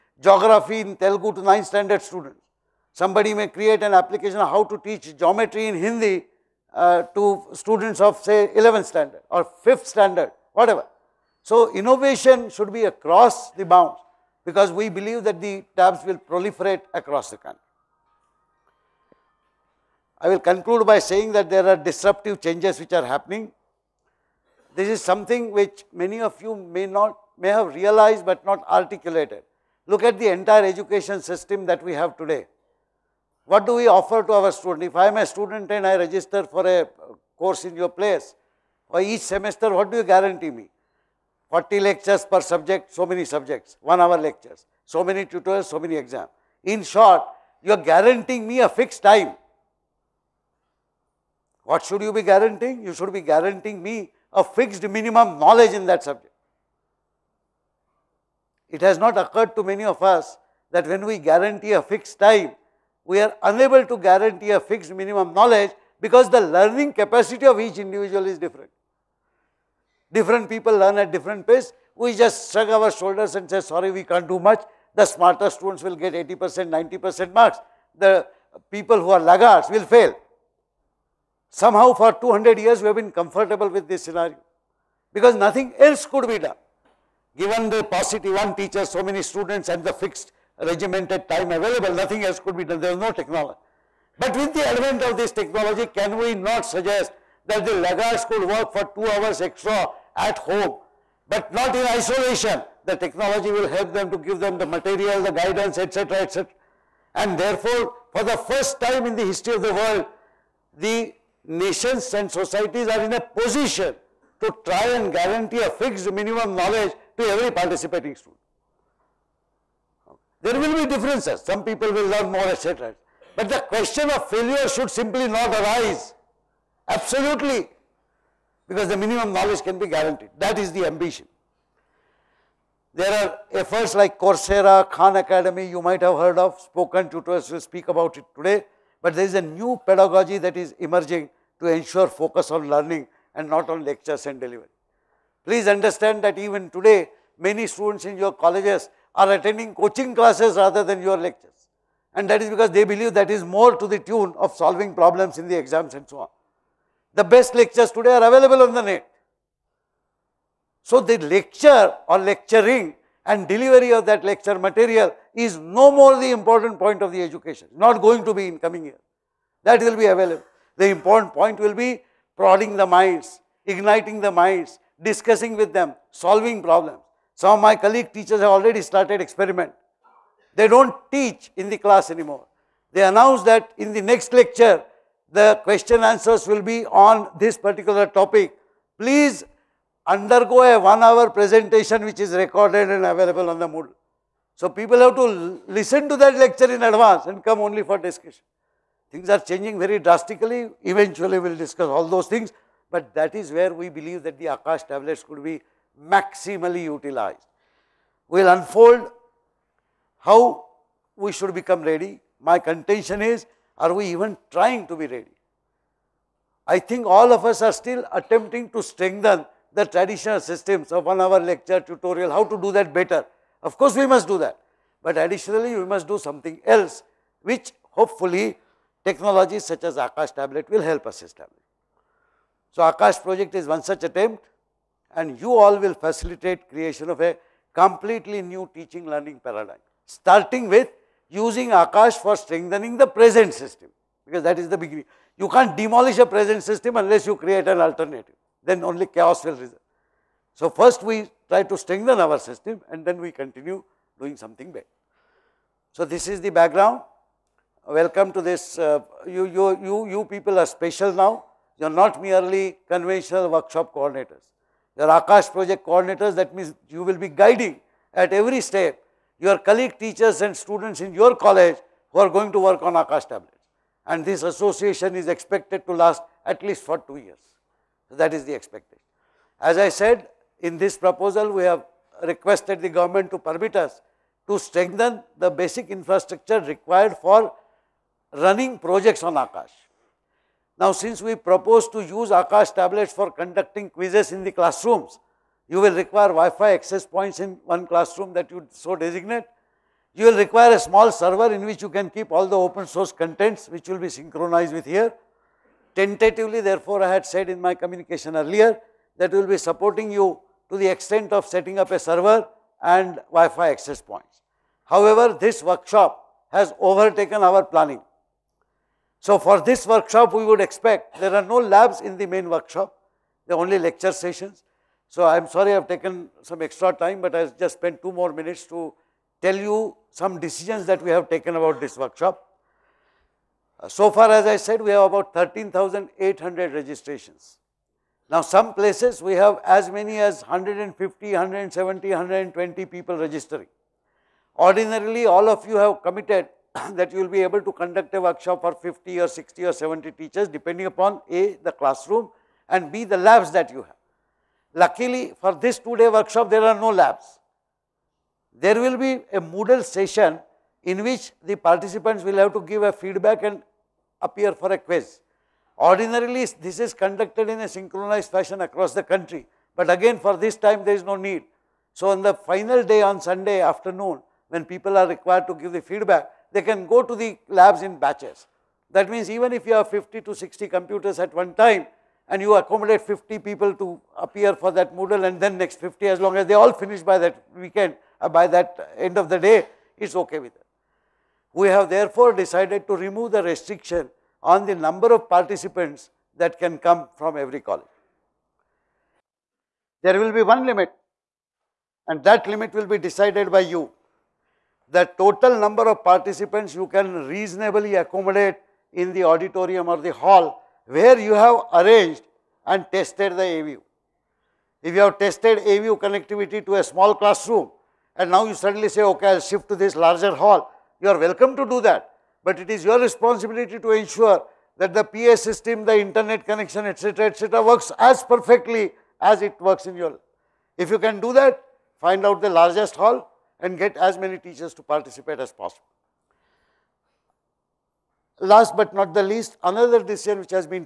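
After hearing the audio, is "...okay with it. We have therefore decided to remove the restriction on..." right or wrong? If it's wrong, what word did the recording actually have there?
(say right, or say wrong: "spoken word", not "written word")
right.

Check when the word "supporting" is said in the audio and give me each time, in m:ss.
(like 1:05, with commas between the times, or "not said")
5:09.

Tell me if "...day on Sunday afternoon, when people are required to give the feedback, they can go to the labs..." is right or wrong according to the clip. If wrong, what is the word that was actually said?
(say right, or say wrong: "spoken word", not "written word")
right.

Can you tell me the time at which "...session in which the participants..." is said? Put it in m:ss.
5:59.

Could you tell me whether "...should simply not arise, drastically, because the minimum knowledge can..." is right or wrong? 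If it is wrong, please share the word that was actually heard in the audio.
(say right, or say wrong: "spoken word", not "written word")
wrong: "absolutely", not "drastically".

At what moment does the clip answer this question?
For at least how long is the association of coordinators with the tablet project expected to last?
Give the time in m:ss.
4:36.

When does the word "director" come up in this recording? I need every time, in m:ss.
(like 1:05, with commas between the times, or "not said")
not said.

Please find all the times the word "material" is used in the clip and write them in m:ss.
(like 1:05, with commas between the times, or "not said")
1:44, 2:44.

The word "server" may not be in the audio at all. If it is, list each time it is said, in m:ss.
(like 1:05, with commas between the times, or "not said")
5:01, 5:11.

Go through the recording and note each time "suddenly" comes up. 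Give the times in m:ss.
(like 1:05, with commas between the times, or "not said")
6:58.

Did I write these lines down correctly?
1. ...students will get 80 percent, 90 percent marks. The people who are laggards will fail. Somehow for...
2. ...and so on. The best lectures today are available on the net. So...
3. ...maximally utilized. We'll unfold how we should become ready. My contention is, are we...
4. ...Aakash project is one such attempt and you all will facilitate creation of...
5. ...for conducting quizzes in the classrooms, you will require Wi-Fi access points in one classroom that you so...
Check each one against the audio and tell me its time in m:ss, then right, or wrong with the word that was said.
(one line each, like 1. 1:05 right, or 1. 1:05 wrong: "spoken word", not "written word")
1. 1:15 right
2. 2:35 right
3. 3:26 right
4. 3:52 right
5. 4:53 right.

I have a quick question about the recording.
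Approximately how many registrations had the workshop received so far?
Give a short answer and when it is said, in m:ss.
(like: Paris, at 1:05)
13,800, at 5:35.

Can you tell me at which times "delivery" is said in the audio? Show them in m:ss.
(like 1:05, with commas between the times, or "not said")
2:24, 2:43.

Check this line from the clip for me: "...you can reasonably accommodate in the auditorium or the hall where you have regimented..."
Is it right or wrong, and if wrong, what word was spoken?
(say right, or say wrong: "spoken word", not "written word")
wrong: "arranged", not "regimented".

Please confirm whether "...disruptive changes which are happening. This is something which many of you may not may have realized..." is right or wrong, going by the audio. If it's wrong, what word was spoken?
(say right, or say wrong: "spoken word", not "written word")
right.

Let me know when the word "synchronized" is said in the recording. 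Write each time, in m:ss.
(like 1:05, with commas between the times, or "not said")
5:04, 6:07.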